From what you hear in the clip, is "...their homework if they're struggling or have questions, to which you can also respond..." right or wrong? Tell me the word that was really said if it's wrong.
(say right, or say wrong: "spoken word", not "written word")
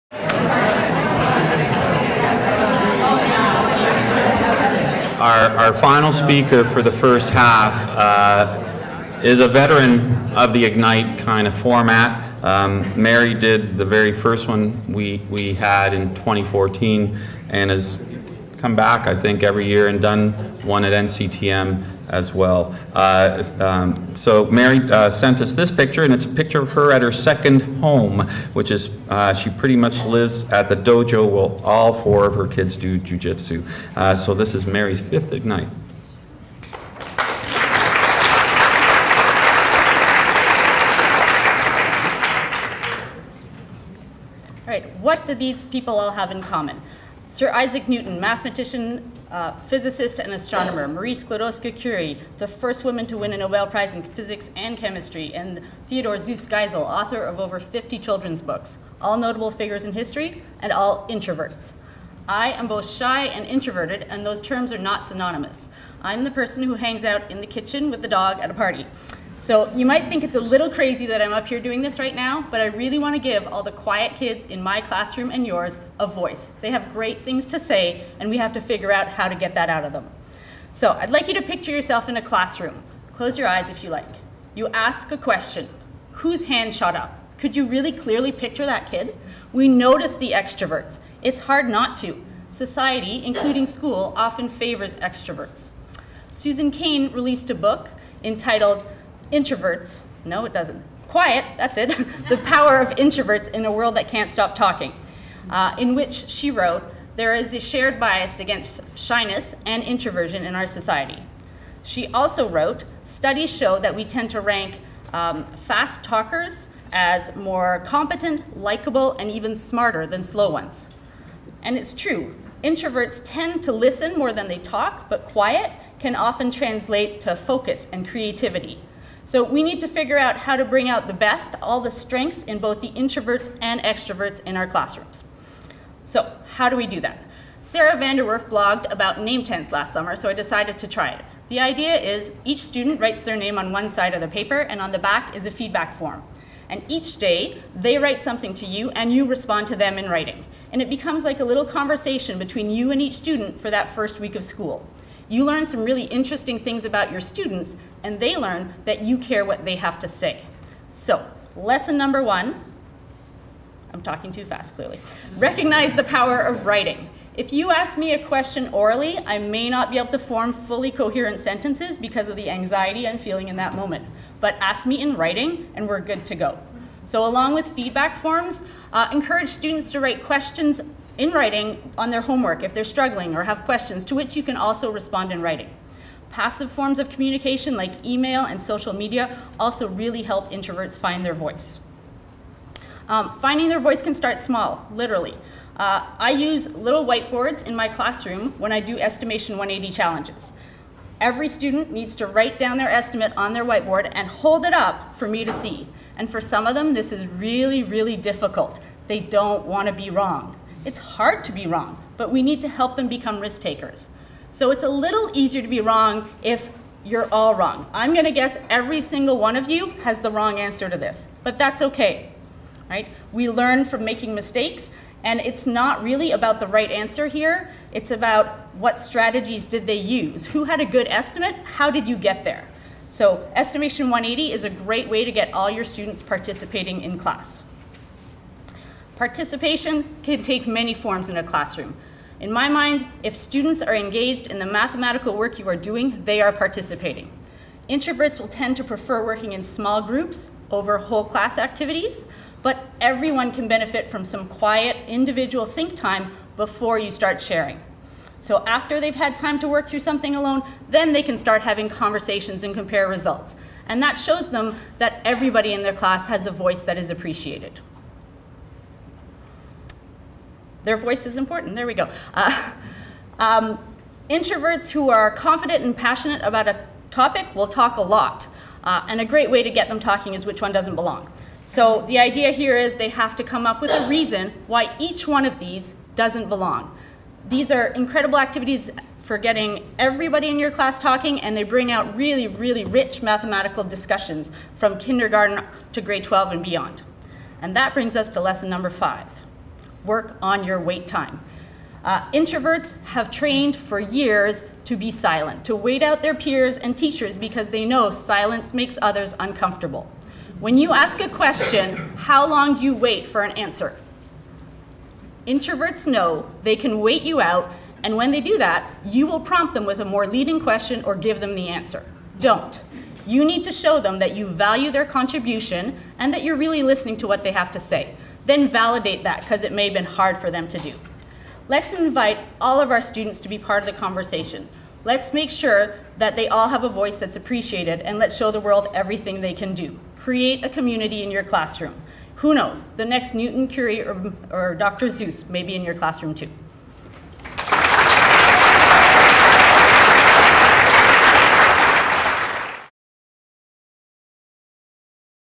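right.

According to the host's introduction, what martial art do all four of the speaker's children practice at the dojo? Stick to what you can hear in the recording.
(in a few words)
Jujitsu.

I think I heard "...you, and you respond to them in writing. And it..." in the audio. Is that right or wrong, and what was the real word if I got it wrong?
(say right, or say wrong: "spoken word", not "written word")
right.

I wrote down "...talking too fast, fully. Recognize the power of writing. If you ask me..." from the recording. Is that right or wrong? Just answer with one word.
wrong.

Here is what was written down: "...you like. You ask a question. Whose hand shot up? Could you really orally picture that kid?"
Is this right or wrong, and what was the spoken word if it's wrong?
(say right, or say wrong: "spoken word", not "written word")
wrong: "clearly", not "orally".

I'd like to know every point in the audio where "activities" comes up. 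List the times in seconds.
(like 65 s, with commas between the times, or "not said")
251 s, 288 s.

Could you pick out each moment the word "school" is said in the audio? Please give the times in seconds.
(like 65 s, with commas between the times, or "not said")
93 s, 154 s.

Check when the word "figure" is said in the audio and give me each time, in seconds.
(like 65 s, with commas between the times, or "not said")
59 s, 78 s, 129 s.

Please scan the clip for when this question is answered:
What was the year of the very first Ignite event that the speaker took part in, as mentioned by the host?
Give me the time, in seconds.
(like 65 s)
16 s.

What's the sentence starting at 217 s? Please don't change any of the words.
I'm gonna guess every single one of you has the wrong answer to this, but that's okay, right?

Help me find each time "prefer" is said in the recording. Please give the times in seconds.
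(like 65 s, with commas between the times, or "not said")
248 s.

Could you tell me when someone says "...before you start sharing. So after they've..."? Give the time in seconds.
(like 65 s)
256 s.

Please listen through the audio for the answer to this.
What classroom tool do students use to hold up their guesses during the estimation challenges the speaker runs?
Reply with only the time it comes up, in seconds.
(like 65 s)
196 s.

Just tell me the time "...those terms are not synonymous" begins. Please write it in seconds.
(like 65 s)
64 s.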